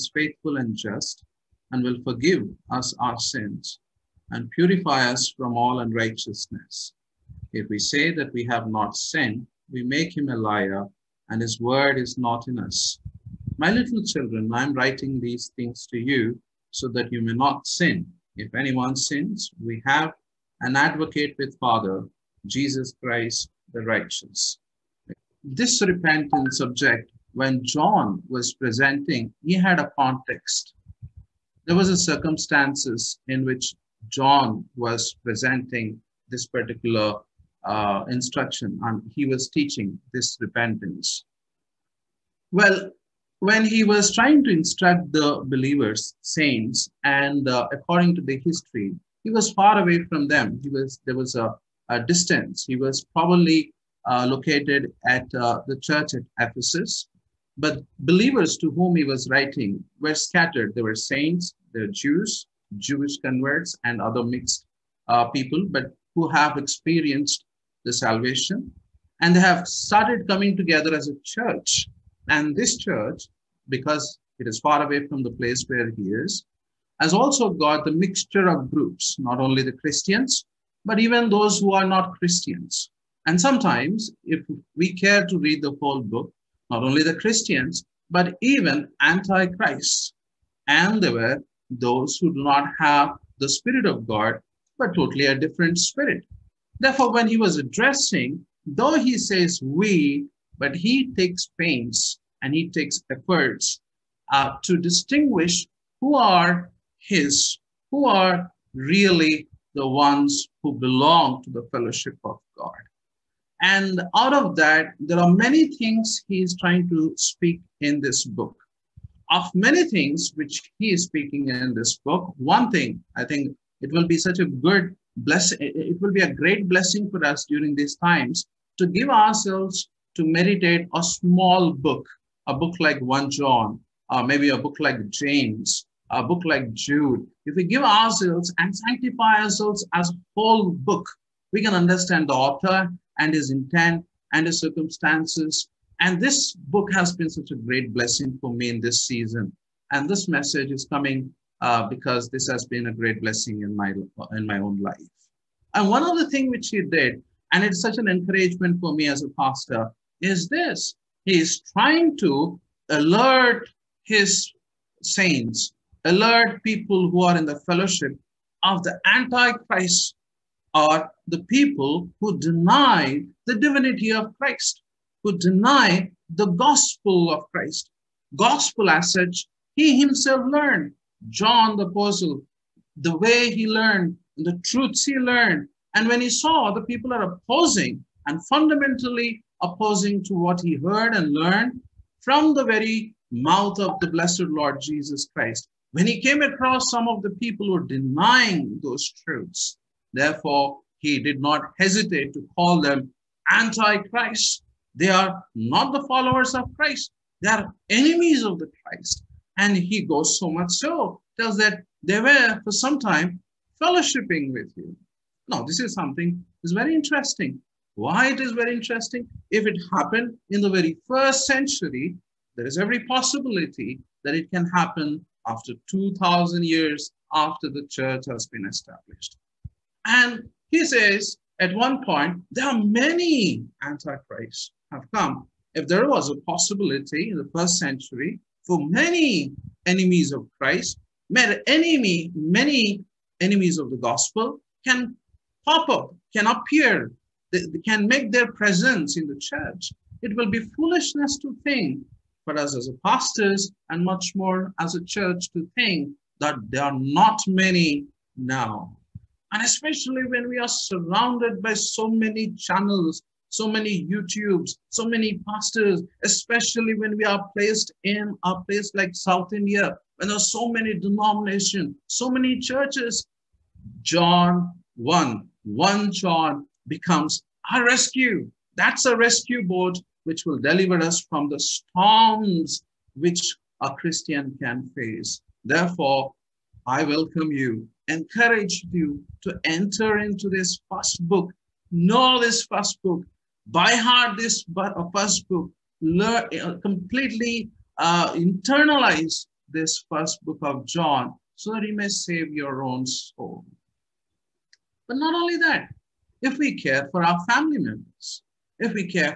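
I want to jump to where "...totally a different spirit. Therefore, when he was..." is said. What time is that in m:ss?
1:34.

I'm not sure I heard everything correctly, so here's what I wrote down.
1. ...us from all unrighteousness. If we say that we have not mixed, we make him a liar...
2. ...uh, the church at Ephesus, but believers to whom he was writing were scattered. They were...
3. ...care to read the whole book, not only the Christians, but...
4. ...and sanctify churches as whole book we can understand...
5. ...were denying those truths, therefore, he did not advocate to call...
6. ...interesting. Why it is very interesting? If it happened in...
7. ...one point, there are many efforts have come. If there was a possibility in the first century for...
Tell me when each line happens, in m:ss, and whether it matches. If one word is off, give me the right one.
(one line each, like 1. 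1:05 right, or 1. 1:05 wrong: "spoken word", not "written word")
1. 0:05 wrong: "sinned", not "mixed"
2. 0:55 right
3. 1:24 right
4. 2:18 wrong: "ourselves", not "churches"
5. 3:17 wrong: "hesitate", not "advocate"
6. 3:36 right
7. 3:51 wrong: "antichrists", not "efforts".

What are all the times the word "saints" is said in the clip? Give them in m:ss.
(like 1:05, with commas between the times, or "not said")
0:46, 1:00, 2:45.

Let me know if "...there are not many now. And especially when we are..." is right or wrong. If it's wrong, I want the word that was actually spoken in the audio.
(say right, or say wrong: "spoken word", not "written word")
right.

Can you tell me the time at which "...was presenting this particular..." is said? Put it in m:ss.
0:34.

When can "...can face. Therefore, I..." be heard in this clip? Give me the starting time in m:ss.
4:44.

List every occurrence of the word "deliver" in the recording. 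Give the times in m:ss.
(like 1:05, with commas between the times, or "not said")
4:40.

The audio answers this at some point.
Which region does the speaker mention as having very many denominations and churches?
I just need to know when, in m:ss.
4:29.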